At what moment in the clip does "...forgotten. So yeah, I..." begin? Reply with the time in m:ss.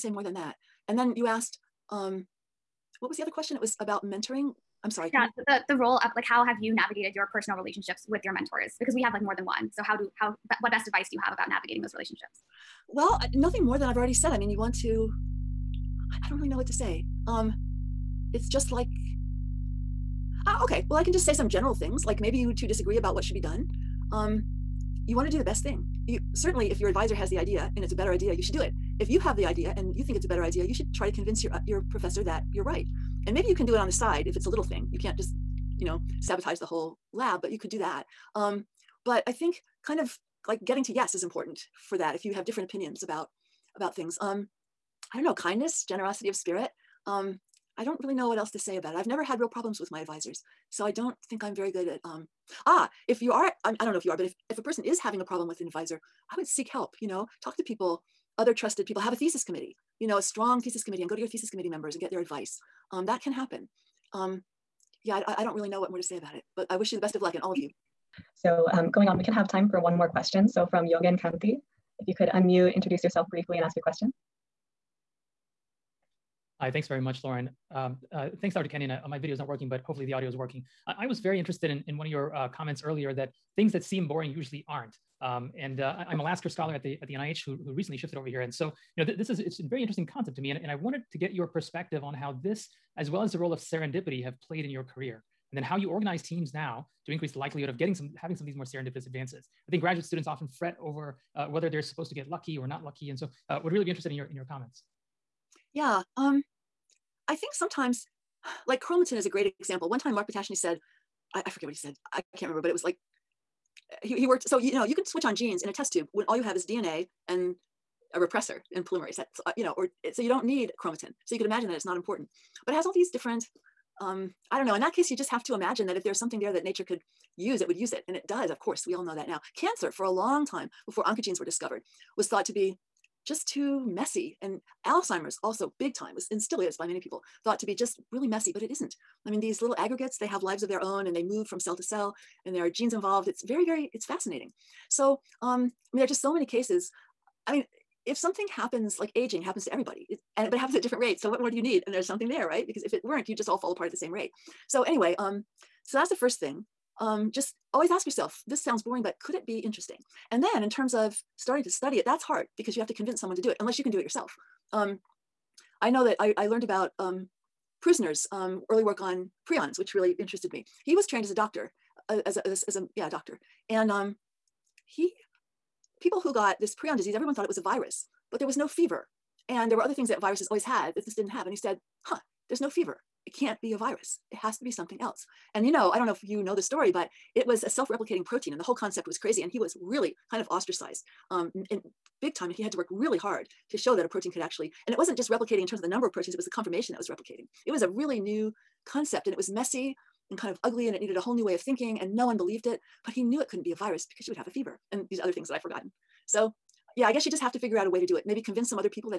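3:25.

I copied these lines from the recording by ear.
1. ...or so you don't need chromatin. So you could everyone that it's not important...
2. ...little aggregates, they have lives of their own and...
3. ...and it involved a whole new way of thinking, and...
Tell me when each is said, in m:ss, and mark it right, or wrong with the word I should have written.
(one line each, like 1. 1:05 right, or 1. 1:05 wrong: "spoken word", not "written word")
1. 1:59 wrong: "imagine", not "everyone"
2. 2:19 right
3. 3:20 wrong: "needed", not "involved".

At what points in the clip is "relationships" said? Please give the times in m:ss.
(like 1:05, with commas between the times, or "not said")
0:07, 0:11.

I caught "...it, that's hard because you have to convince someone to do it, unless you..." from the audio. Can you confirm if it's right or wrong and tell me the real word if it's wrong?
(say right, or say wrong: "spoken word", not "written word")
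right.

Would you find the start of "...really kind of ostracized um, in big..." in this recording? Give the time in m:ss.
3:09.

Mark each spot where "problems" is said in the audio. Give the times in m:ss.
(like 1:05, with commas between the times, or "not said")
0:49, 0:55.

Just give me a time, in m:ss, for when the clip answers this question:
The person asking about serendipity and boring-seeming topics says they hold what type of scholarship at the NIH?
1:26.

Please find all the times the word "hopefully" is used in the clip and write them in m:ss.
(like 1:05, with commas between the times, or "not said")
1:19.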